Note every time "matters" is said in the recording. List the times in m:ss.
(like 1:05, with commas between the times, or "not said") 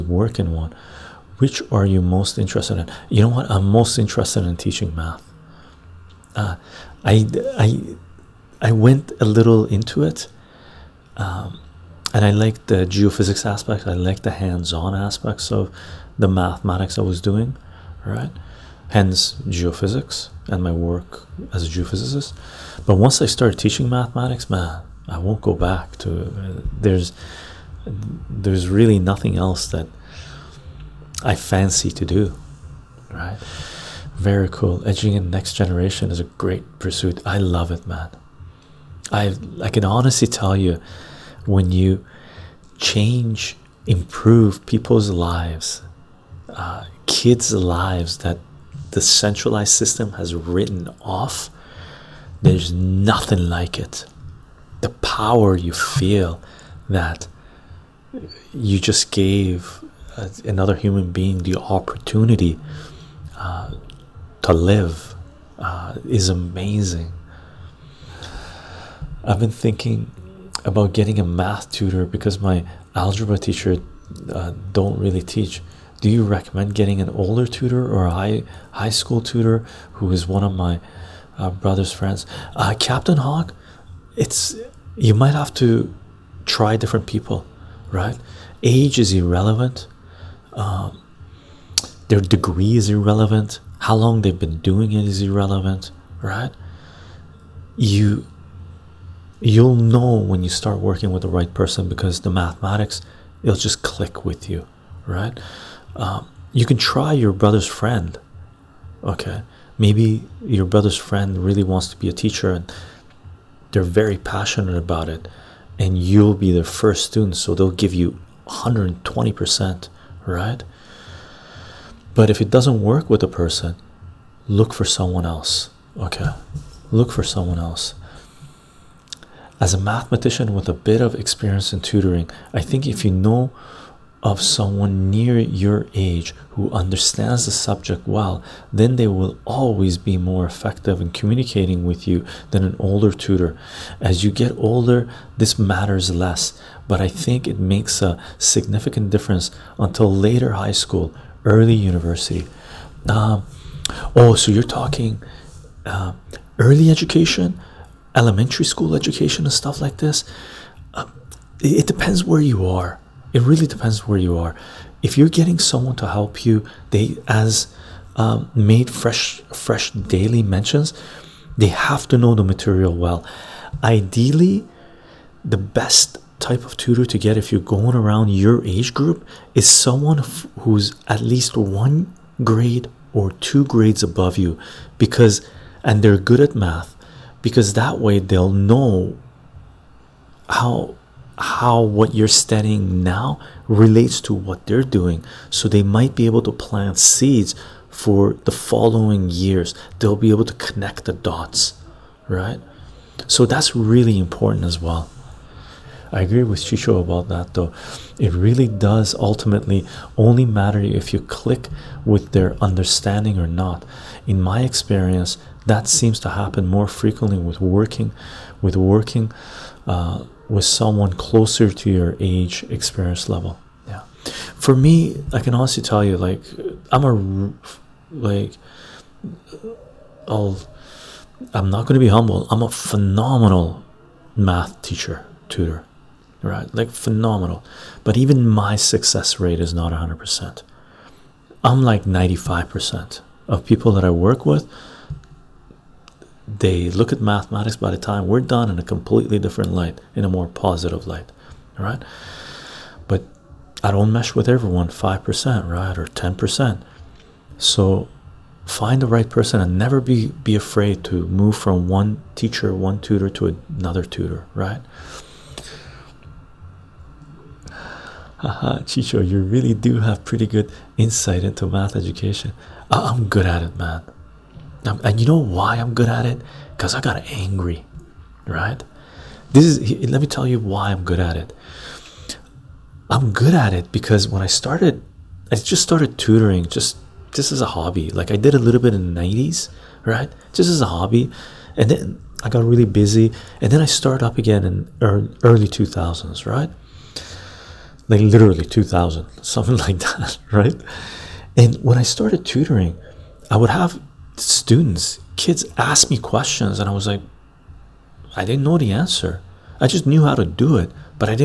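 2:25, 3:30.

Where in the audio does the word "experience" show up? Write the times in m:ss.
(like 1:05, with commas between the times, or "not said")
2:11, 3:34, 3:42.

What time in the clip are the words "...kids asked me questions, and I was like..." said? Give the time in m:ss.
5:05.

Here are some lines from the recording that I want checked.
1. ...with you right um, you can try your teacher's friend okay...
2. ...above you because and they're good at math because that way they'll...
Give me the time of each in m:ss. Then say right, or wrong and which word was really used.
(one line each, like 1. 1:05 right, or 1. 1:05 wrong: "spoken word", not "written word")
1. 1:44 wrong: "brother", not "teacher"
2. 3:04 right.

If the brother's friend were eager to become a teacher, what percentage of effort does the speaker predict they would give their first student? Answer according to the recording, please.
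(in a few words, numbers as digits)
120%.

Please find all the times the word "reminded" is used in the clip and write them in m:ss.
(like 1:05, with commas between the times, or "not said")
not said.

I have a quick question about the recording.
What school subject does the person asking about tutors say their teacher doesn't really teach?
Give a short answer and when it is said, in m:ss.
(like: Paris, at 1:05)
Algebra, at 1:12.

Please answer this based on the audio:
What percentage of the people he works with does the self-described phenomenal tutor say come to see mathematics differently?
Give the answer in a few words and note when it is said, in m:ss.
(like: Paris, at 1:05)
95%, at 4:02.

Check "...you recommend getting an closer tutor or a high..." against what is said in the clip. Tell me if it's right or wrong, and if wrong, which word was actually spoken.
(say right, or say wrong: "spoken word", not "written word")
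wrong: "older", not "closer".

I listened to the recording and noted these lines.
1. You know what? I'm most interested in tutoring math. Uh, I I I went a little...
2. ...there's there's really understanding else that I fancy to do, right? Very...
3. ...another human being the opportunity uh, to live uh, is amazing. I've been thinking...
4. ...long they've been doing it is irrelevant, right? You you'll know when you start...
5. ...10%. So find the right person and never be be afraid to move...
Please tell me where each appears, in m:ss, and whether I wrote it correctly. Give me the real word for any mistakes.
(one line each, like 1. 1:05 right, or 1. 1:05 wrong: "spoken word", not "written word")
1. 0:03 wrong: "teaching", not "tutoring"
2. 0:26 wrong: "nothing", not "understanding"
3. 1:00 right
4. 1:33 right
5. 4:16 right.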